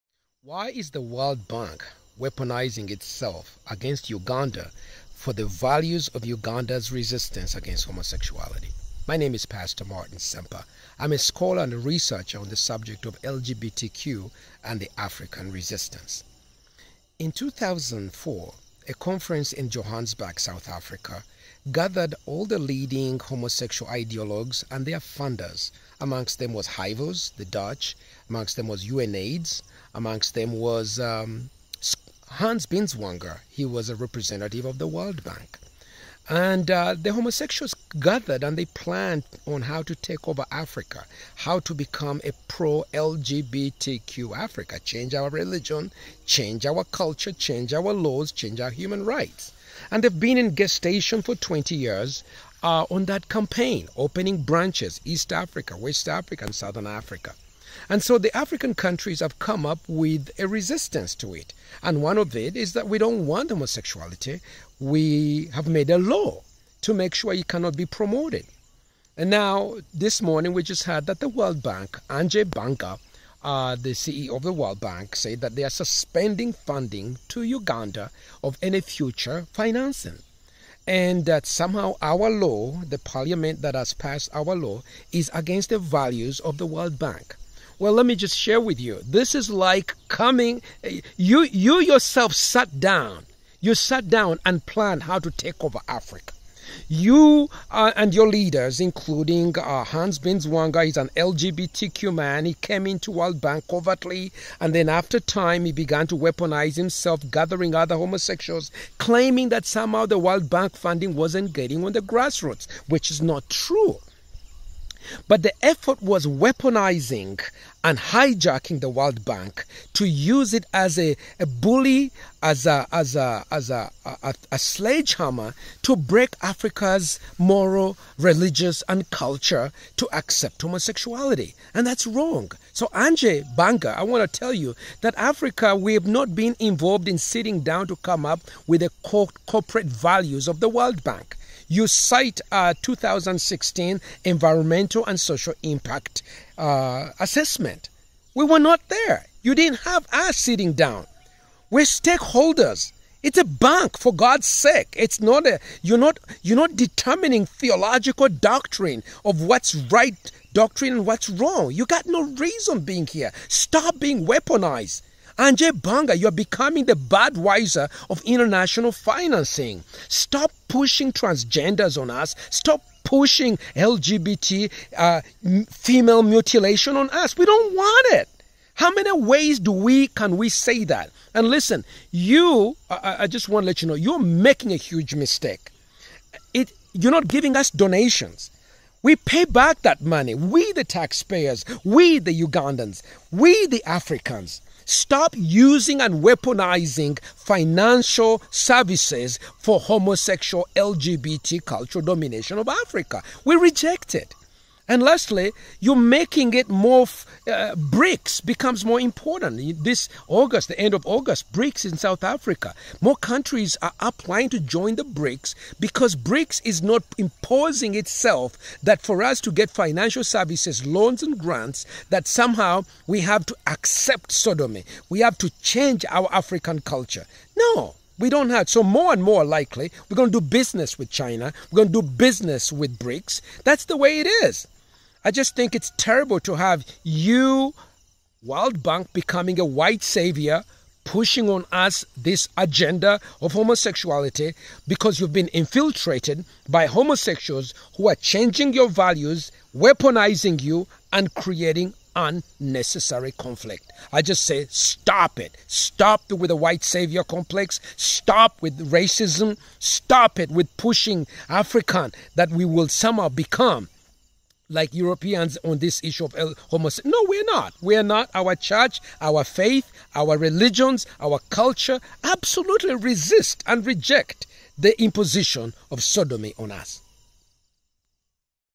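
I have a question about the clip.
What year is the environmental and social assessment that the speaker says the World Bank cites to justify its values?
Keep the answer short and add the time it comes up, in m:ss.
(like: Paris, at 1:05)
2016, at 2:22.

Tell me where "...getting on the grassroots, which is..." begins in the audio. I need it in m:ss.
1:51.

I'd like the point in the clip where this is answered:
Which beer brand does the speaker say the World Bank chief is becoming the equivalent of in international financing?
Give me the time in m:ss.
2:46.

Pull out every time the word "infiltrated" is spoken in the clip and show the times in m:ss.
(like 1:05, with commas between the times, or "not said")
4:05.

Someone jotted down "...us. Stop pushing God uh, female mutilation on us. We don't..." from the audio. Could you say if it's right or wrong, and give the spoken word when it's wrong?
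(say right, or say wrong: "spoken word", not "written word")
wrong: "LGBT", not "God".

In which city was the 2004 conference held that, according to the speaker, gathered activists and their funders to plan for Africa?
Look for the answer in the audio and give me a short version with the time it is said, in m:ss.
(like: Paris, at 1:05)
Johannesburg, at 0:19.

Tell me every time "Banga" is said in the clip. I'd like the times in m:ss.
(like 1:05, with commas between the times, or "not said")
1:12, 2:13, 2:45.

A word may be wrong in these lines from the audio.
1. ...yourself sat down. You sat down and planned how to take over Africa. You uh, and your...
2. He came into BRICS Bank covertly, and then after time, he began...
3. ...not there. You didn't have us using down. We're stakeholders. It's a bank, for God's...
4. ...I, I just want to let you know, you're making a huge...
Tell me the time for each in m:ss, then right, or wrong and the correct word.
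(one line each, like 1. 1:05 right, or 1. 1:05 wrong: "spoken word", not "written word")
1. 1:31 right
2. 1:42 wrong: "World", not "BRICS"
3. 2:28 wrong: "sitting", not "using"
4. 3:02 right.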